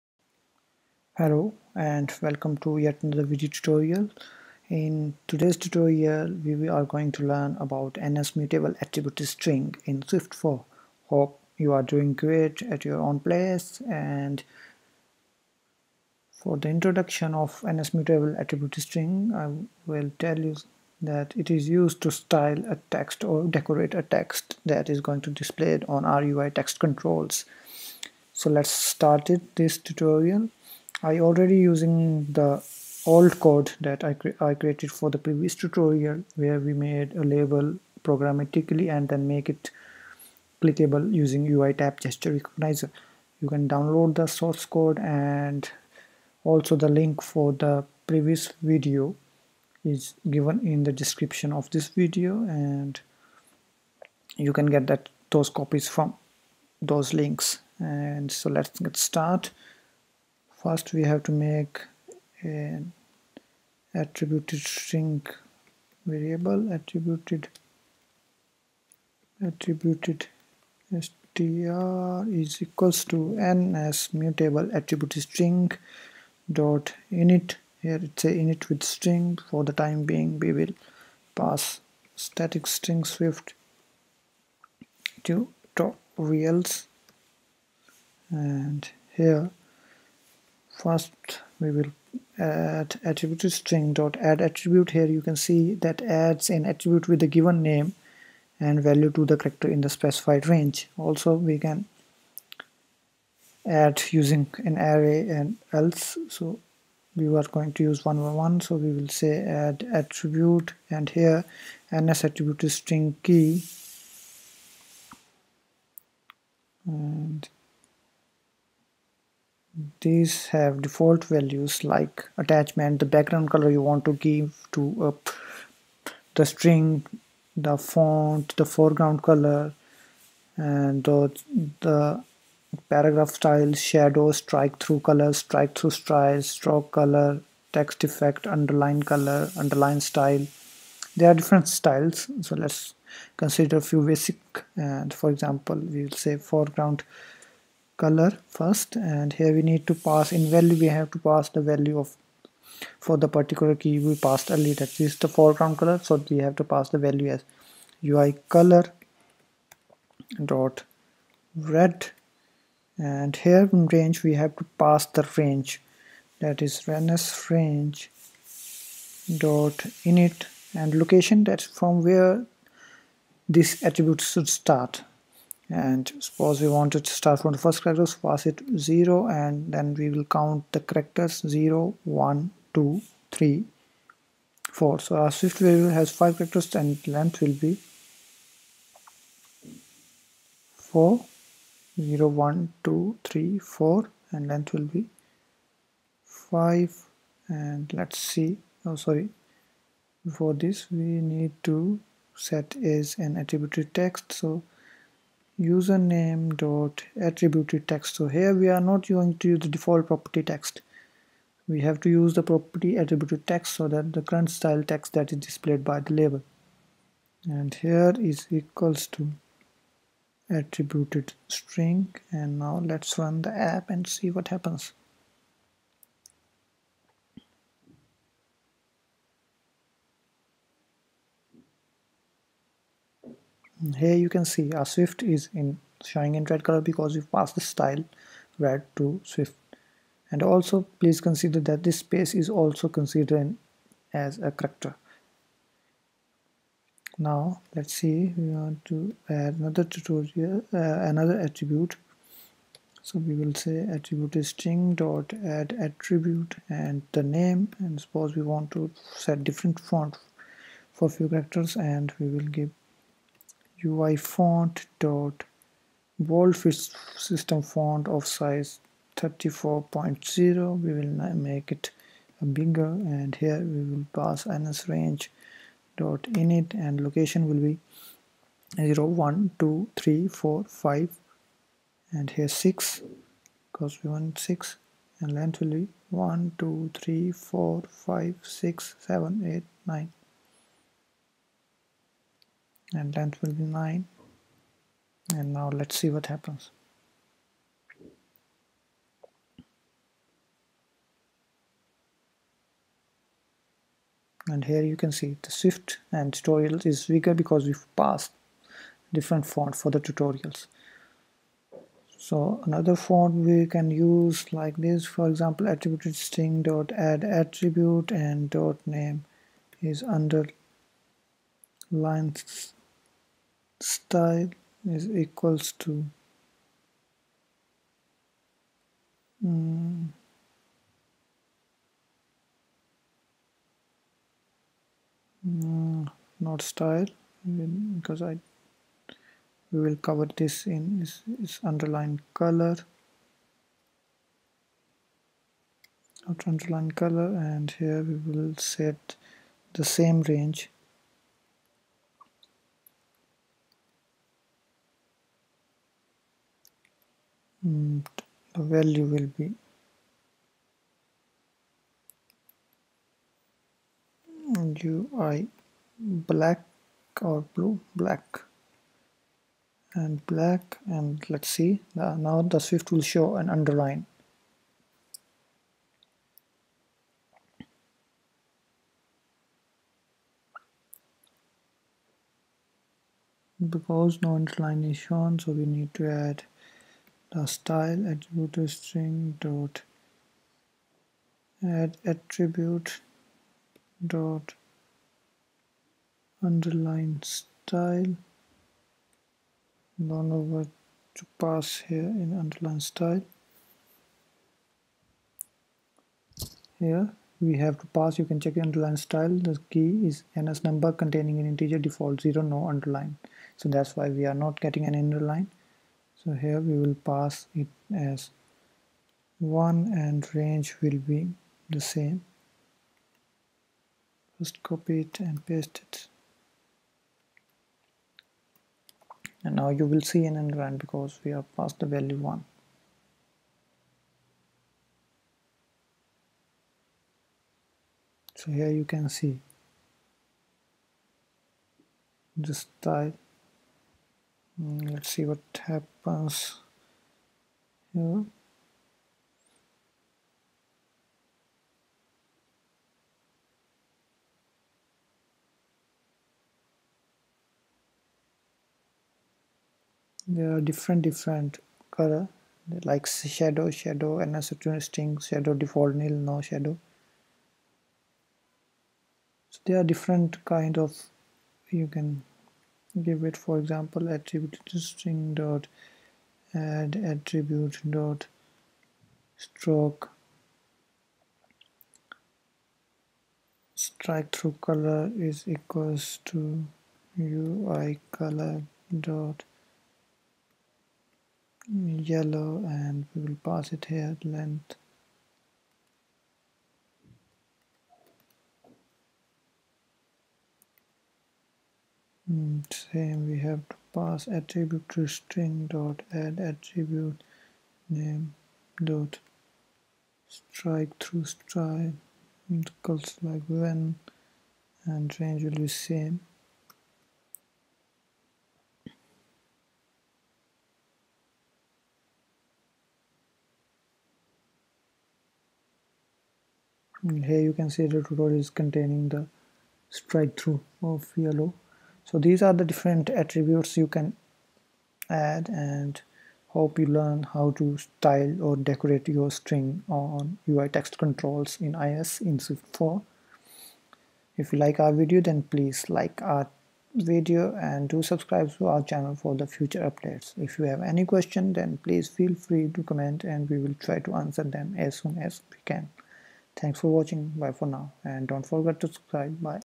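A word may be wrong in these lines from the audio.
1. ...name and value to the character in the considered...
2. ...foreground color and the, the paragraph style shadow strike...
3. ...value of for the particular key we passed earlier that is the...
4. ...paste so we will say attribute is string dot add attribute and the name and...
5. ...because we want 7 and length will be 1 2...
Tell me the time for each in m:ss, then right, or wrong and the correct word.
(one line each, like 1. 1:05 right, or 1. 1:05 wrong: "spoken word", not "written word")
1. 1:37 wrong: "specified", not "considered"
2. 2:08 right
3. 2:31 right
4. 4:11 wrong: "attribute", not "paste"
5. 4:43 wrong: "6", not "7".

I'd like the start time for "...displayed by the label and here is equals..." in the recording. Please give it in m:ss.
3:35.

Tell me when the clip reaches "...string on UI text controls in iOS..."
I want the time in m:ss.
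8:59.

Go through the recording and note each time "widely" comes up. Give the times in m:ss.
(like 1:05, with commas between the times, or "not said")
not said.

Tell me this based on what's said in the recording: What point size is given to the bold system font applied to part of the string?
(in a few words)
34.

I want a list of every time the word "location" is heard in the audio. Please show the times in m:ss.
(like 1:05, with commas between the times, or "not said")
2:51, 4:37.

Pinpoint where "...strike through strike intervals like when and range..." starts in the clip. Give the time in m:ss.
8:30.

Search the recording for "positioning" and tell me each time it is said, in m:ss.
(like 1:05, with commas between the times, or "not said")
not said.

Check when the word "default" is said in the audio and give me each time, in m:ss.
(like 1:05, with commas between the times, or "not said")
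2:00, 3:29, 6:51, 7:45.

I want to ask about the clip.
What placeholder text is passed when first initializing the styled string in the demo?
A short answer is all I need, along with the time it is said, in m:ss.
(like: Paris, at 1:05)
Swift 4 tutorials, at 1:23.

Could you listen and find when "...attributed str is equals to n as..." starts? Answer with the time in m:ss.
1:09.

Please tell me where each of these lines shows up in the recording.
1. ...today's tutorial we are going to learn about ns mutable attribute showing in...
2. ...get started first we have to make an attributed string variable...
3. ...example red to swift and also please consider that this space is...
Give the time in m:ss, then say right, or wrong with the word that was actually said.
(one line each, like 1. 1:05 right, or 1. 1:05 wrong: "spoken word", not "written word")
1. 0:05 wrong: "string", not "showing"
2. 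0:58 right
3. 3:57 wrong: "style", not "example".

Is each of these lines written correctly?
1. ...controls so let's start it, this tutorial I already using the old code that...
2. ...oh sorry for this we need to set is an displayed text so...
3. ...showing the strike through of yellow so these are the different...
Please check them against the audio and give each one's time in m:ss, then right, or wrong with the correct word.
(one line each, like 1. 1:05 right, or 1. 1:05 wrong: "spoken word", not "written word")
1. 0:26 right
2. 3:18 wrong: "attributed", not "displayed"
3. 8:48 wrong: "containing", not "showing".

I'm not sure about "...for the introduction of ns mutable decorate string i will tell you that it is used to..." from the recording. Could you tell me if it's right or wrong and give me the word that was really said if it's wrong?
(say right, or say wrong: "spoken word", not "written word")
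wrong: "attribute", not "decorate".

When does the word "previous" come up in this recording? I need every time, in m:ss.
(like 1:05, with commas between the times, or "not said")
0:35, 0:48.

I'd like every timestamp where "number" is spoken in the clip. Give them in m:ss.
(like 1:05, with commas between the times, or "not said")
6:50.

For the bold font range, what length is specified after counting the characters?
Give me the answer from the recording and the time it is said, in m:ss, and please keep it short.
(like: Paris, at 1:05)
9, at 4:53.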